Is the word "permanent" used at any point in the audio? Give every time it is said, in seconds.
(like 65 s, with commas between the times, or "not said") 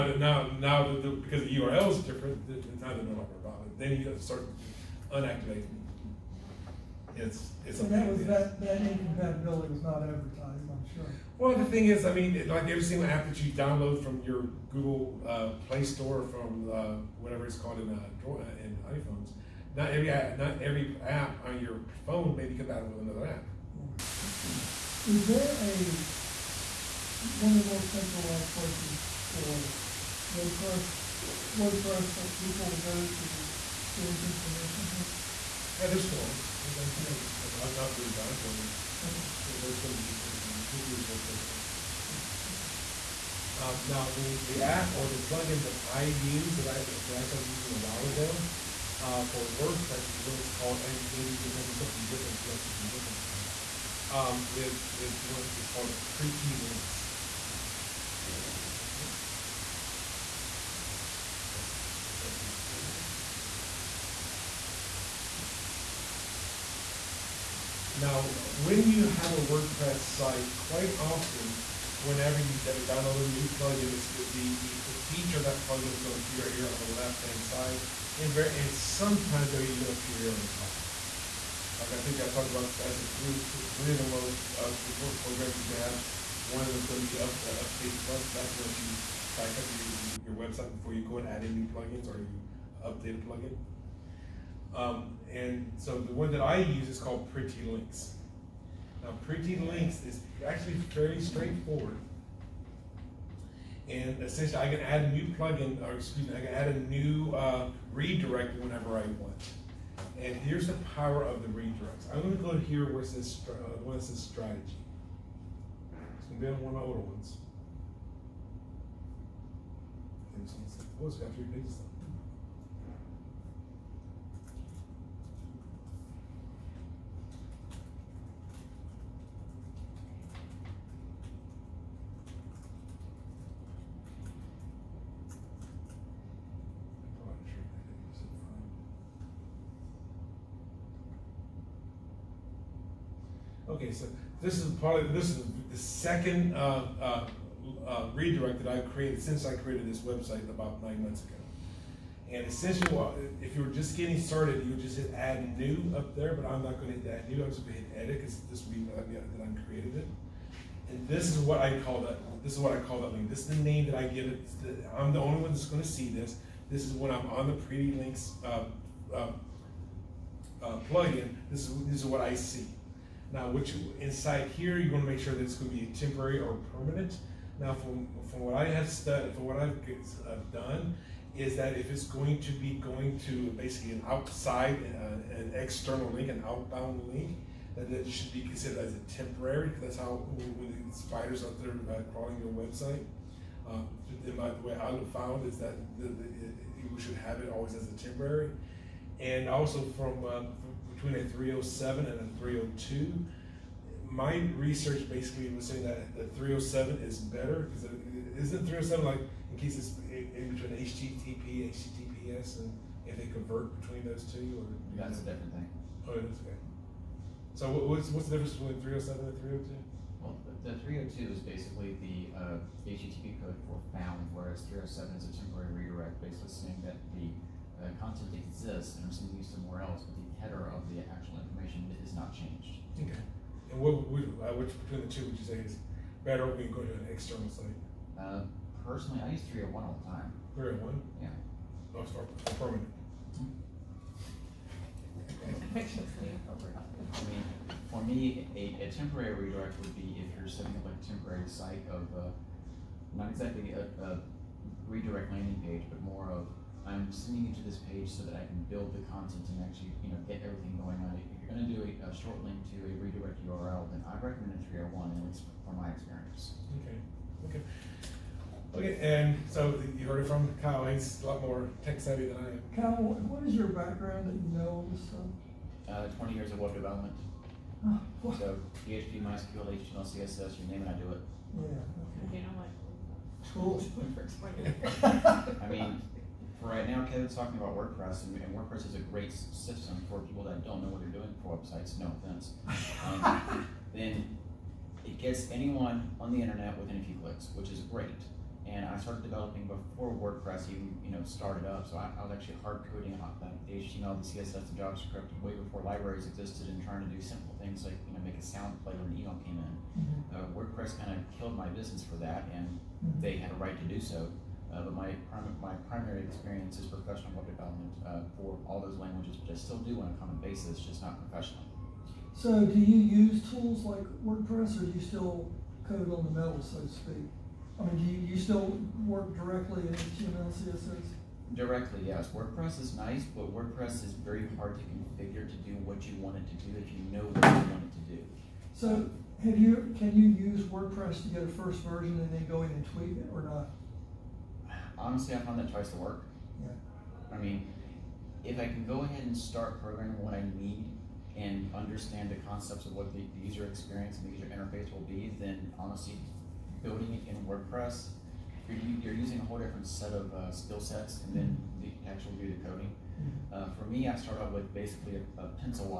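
176 s, 242 s.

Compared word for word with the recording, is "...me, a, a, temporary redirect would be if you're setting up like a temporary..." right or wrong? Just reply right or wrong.
right.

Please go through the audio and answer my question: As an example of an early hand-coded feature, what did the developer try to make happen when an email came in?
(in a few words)
Make a sound play.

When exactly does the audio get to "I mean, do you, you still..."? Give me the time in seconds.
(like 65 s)
327 s.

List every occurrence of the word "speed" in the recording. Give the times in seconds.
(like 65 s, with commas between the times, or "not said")
not said.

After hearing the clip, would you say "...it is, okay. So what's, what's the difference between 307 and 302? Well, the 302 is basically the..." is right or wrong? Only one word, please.
right.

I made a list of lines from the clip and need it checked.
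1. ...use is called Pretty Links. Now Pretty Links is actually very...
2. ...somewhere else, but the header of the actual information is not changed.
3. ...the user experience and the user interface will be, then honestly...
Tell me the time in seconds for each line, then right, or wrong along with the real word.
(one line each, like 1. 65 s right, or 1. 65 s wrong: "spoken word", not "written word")
1. 96 s right
2. 229 s right
3. 353 s right.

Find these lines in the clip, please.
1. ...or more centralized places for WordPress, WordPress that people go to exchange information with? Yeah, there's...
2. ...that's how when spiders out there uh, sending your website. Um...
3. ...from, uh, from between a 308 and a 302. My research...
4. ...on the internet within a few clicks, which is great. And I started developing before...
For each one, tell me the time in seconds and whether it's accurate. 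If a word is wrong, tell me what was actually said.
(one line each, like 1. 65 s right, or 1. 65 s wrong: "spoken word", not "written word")
1. 27 s right
2. 189 s wrong: "crawling", not "sending"
3. 199 s wrong: "307", not "308"
4. 296 s right.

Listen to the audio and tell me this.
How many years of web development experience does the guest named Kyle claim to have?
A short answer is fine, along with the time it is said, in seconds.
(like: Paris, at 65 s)
20 years, at 276 s.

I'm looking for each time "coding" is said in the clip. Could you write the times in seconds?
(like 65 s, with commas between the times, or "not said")
302 s, 362 s.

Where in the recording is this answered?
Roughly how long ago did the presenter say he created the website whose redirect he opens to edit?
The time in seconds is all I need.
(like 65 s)
150 s.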